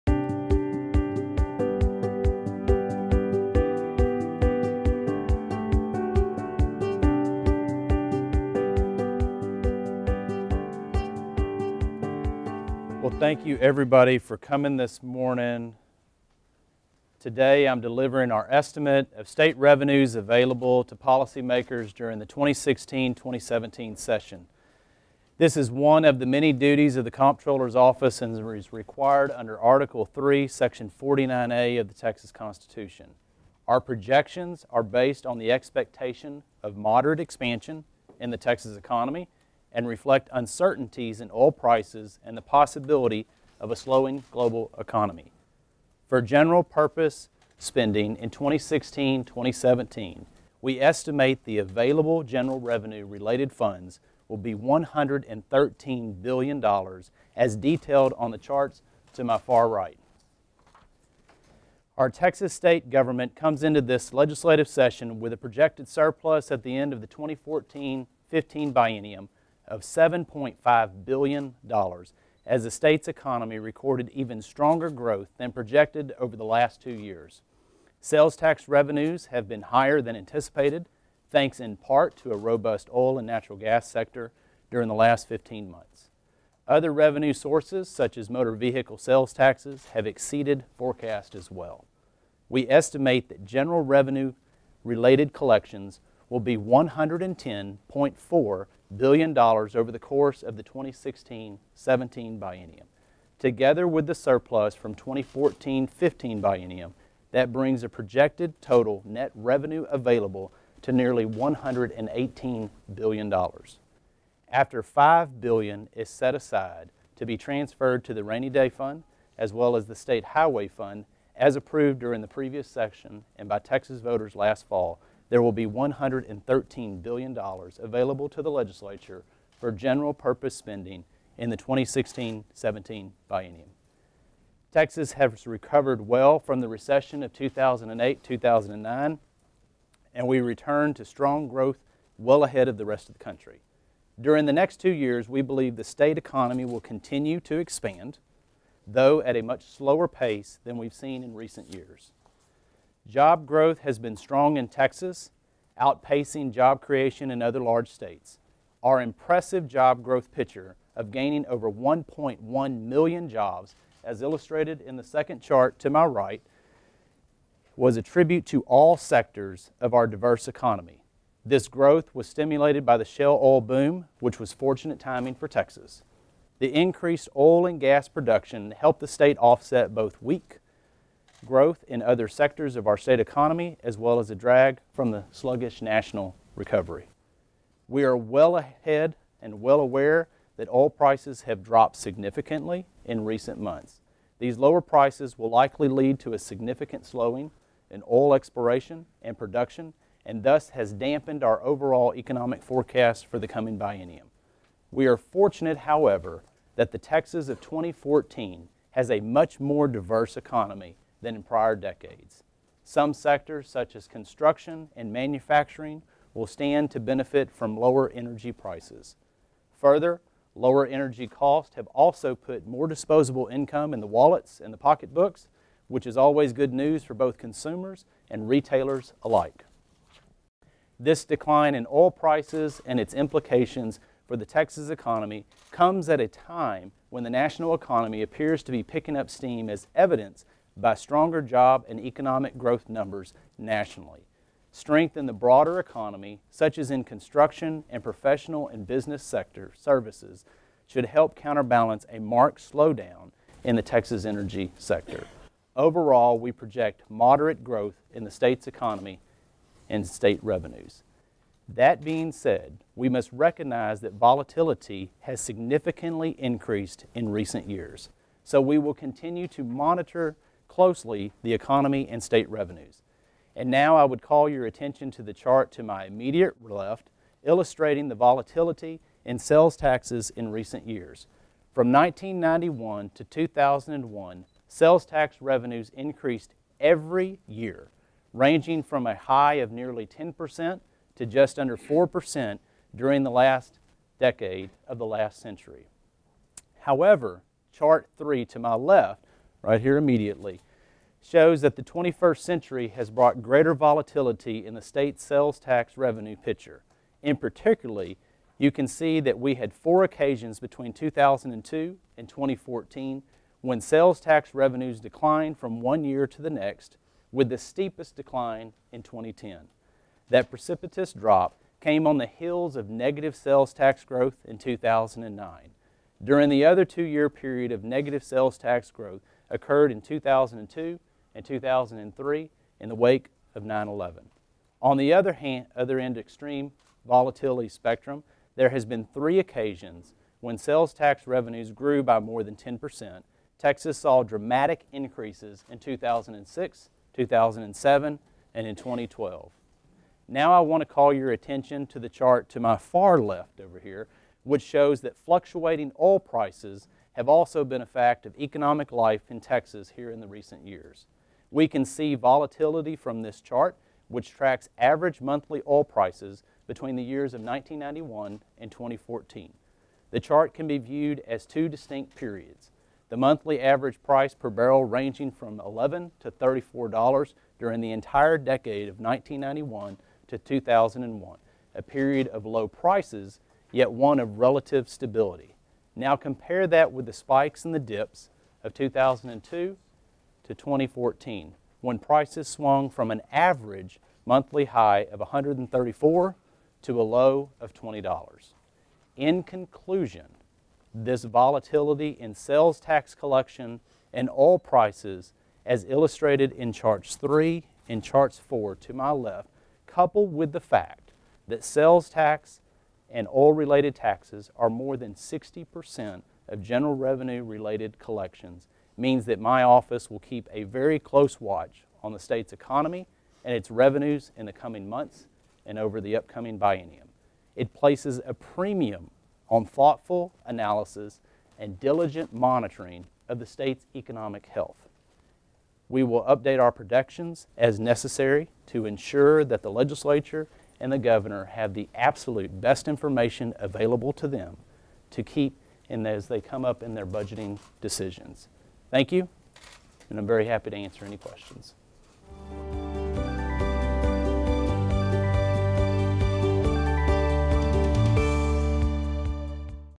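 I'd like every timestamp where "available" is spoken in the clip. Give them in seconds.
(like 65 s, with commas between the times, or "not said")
20 s, 51 s, 109 s, 127 s, 443 s.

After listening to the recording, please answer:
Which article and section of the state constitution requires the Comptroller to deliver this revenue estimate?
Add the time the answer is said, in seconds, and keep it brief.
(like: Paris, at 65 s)
Article 3, Section 49A, at 29 s.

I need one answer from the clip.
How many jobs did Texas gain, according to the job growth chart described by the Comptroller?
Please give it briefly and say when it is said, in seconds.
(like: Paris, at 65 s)
Over 1.1 million, at 161 s.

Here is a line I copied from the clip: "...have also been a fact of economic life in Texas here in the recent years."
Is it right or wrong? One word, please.
right.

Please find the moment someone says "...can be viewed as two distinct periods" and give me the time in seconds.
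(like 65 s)
370 s.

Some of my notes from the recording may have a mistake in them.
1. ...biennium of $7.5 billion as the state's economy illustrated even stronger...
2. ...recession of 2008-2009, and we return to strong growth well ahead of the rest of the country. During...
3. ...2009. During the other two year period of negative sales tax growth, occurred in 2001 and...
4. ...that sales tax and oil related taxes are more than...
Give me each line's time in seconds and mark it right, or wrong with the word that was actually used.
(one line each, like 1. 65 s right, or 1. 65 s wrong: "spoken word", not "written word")
1. 68 s wrong: "recorded", not "illustrated"
2. 136 s right
3. 324 s wrong: "2002", not "2001"
4. 411 s right.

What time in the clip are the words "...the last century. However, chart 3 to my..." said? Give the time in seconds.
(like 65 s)
294 s.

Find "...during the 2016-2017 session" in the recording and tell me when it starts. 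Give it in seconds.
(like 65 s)
21 s.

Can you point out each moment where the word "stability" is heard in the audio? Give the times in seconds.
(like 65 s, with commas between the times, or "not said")
384 s.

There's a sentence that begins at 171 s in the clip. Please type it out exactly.
This growth was stimulated by the shale oil boom, which was fortunate timing for Texas.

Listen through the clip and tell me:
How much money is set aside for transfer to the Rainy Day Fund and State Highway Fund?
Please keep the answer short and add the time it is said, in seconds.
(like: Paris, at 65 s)
$5 billion, at 114 s.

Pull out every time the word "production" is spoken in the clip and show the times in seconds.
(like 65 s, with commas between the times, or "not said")
178 s, 199 s.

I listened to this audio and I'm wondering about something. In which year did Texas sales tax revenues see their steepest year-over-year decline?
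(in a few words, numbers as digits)
2010.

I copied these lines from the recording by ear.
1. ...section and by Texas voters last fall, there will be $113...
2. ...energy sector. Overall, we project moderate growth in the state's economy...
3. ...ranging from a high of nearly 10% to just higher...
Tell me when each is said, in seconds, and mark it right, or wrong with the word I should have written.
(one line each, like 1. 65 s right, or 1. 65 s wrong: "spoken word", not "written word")
1. 122 s right
2. 254 s right
3. 288 s wrong: "under", not "higher".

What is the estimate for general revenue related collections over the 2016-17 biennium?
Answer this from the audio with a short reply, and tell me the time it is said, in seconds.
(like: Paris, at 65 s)
$110.4 billion, at 96 s.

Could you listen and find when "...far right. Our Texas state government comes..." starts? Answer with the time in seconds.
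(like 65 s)
59 s.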